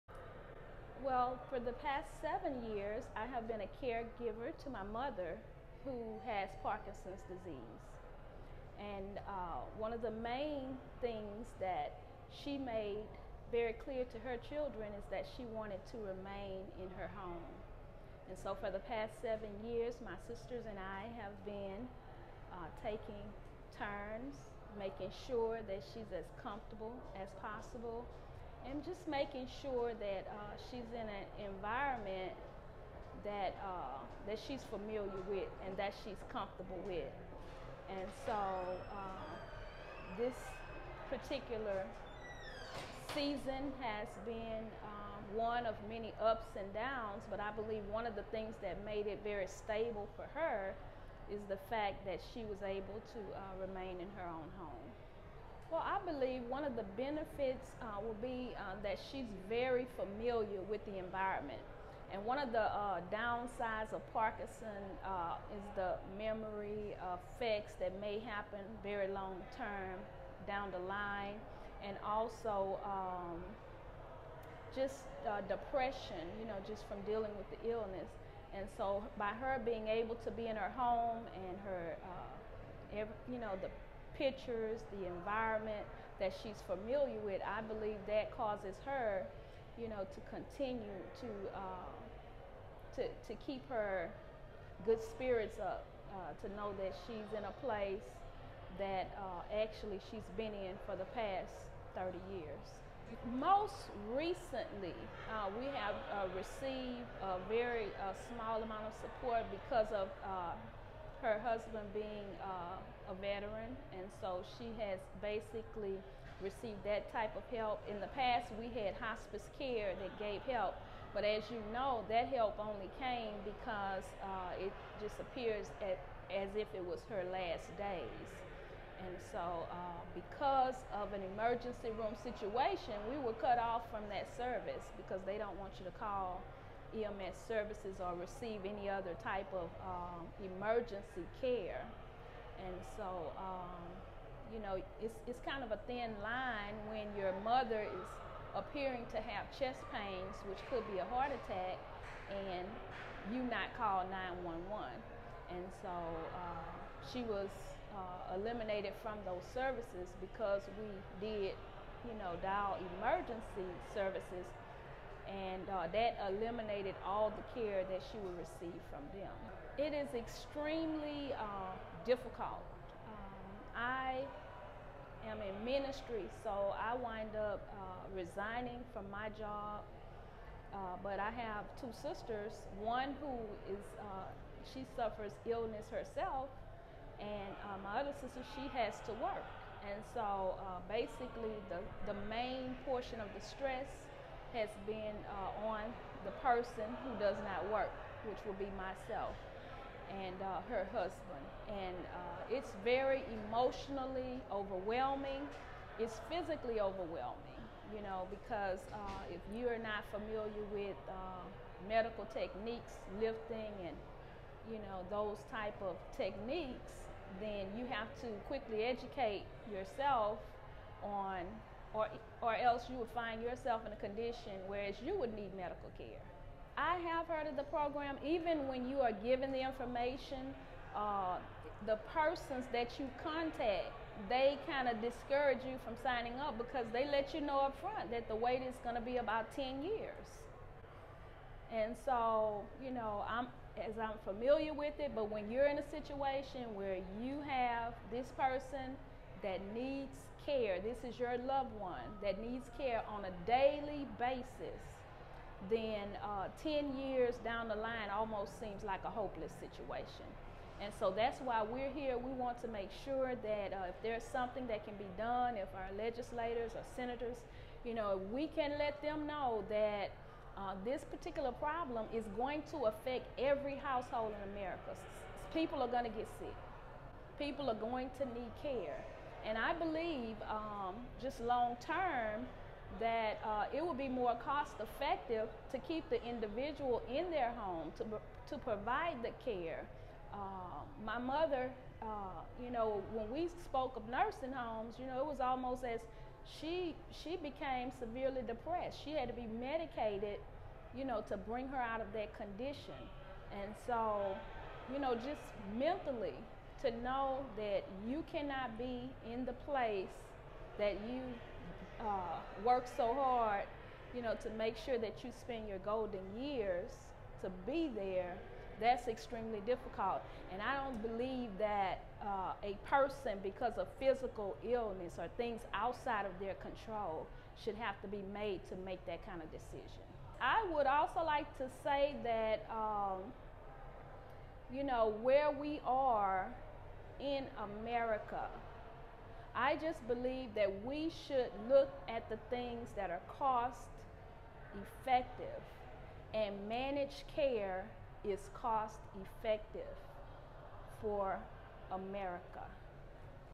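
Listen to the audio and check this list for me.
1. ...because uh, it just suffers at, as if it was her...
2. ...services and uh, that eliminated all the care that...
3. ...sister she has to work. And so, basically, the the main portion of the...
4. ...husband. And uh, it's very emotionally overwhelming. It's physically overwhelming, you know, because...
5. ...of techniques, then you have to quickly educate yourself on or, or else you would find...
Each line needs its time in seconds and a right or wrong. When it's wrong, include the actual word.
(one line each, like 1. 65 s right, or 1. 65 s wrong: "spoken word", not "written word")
1. 123 s wrong: "appears", not "suffers"
2. 163 s right
3. 188 s right
4. 200 s right
5. 215 s right.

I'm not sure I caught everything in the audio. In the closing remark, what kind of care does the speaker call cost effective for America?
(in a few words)
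managed care.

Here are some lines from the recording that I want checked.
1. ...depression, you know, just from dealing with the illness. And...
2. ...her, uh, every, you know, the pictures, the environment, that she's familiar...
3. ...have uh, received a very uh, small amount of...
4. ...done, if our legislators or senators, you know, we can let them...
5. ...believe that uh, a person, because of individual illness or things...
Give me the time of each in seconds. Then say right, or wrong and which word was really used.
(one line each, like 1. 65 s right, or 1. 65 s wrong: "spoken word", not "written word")
1. 75 s right
2. 81 s right
3. 105 s right
4. 265 s right
5. 321 s wrong: "physical", not "individual".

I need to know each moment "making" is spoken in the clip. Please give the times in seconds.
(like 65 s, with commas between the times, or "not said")
24 s, 29 s.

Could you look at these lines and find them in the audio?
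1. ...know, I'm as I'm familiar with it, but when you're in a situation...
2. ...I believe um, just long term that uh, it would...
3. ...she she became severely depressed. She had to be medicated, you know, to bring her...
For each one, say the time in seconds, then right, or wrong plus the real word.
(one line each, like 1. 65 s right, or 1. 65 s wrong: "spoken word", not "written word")
1. 242 s right
2. 279 s right
3. 296 s right.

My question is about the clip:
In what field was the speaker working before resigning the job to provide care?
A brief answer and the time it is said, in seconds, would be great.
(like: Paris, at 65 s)
ministry, at 175 s.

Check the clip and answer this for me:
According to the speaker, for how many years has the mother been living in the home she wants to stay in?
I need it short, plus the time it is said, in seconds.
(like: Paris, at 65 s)
30 years, at 101 s.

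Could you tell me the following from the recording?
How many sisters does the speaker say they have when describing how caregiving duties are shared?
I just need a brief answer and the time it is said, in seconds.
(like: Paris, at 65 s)
2, at 181 s.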